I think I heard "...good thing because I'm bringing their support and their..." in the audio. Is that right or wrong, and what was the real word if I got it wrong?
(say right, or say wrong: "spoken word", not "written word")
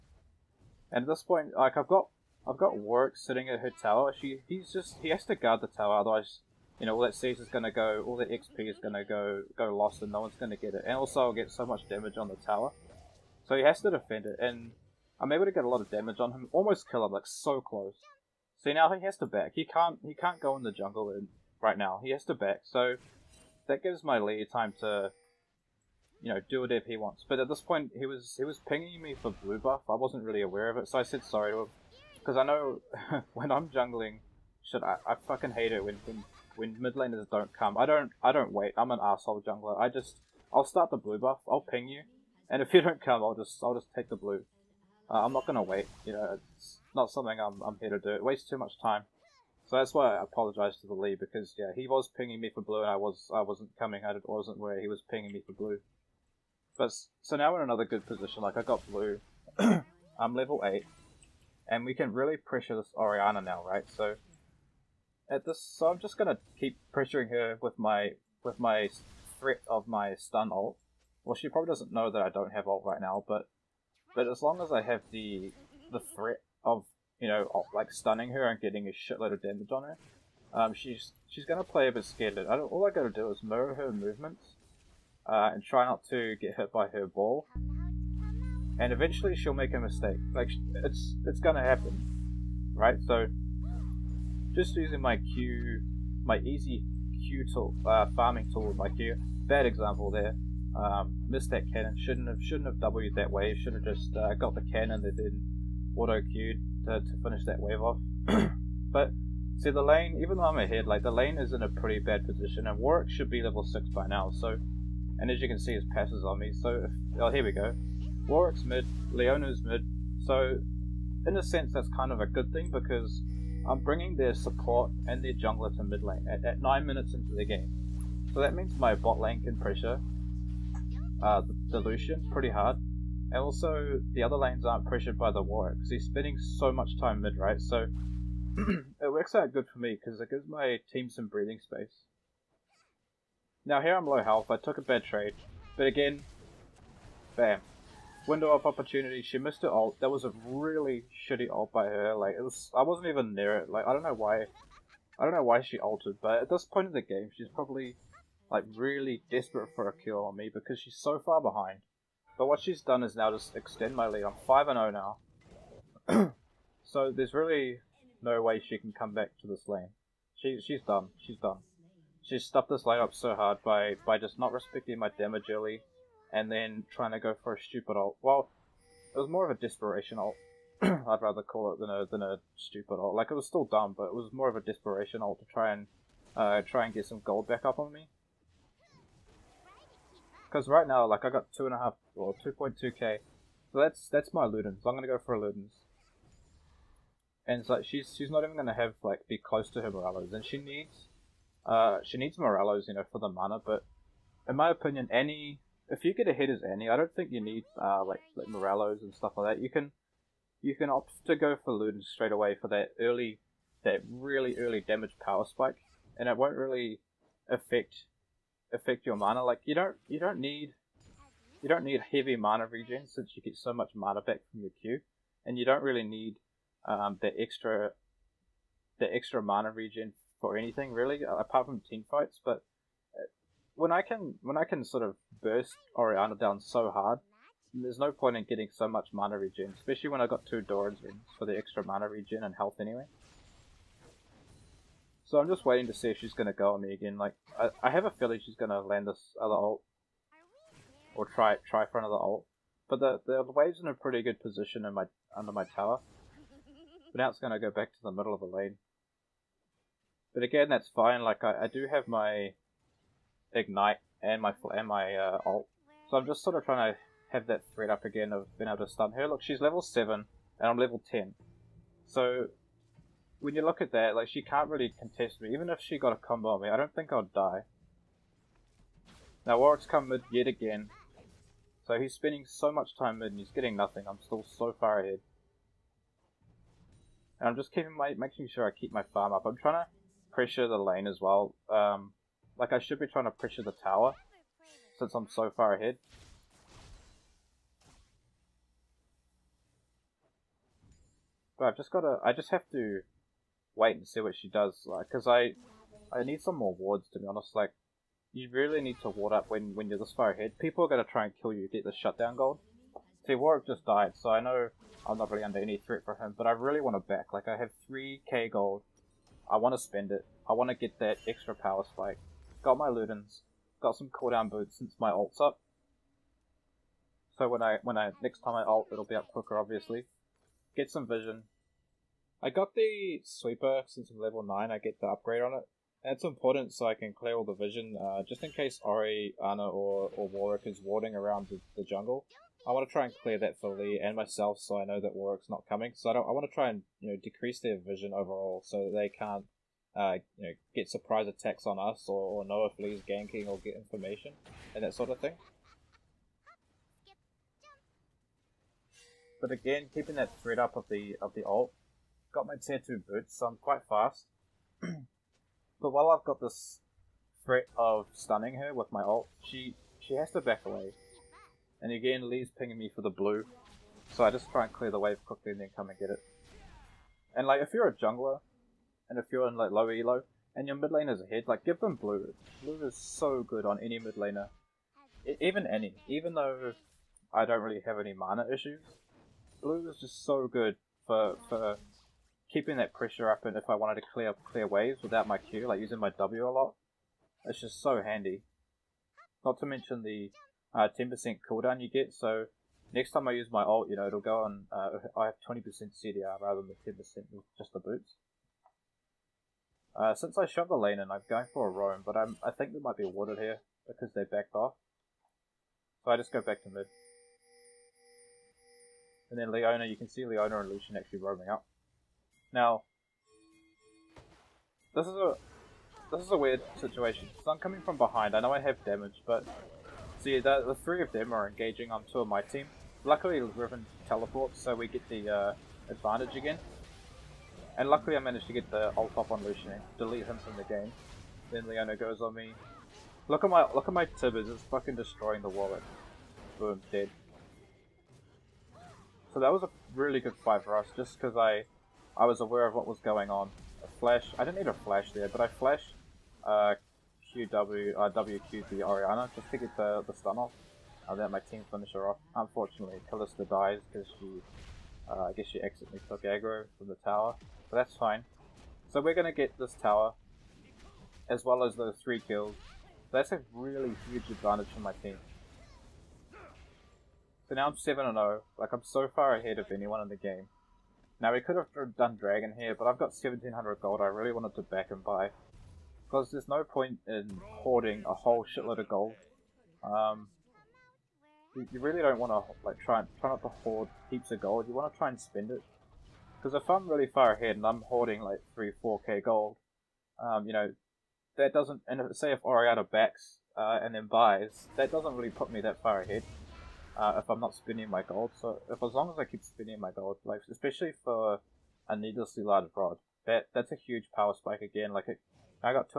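right.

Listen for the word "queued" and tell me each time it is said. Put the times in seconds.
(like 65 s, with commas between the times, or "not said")
106 s.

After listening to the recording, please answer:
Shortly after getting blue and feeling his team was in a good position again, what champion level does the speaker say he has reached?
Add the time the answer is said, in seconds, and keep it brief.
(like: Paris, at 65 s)
8, at 60 s.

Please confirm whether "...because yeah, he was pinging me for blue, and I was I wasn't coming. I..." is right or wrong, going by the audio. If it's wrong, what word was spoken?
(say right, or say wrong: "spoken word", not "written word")
right.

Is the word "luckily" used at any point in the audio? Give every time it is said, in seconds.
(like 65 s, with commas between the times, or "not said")
433 s, 437 s.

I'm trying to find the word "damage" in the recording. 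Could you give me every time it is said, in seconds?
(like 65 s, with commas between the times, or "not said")
11 s, 15 s, 79 s, 175 s, 214 s, 428 s.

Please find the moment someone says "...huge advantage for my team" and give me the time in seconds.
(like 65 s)
474 s.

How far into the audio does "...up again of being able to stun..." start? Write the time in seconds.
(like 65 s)
267 s.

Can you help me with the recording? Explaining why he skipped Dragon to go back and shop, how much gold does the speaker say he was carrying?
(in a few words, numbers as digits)
1700.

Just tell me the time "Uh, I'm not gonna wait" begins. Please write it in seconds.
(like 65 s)
45 s.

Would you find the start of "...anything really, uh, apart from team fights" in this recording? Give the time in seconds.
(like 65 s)
230 s.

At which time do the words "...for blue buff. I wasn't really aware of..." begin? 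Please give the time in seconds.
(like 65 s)
29 s.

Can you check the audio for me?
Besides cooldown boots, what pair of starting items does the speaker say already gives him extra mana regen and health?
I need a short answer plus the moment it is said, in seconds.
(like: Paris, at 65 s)
Two Doran's Rings, at 240 s.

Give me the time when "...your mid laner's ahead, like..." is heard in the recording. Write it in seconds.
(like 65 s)
380 s.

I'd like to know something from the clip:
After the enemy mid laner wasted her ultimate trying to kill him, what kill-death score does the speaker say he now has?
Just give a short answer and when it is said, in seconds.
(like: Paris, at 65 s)
5-0, at 164 s.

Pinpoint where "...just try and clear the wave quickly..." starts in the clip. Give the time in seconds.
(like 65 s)
374 s.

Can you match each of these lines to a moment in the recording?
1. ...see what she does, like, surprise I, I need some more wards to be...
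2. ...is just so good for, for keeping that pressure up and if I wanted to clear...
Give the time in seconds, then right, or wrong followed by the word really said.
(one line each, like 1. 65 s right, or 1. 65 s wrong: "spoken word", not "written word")
1. 304 s wrong: "cause", not "surprise"
2. 389 s right.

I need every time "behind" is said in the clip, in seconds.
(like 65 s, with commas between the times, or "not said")
161 s, 427 s.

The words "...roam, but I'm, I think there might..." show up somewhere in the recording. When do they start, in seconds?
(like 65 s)
411 s.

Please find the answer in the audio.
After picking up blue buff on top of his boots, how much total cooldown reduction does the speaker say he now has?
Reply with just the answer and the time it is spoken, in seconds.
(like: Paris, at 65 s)
20%, at 405 s.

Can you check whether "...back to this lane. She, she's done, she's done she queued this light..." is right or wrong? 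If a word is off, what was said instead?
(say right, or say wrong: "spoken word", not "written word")
wrong: "stuffed", not "queued".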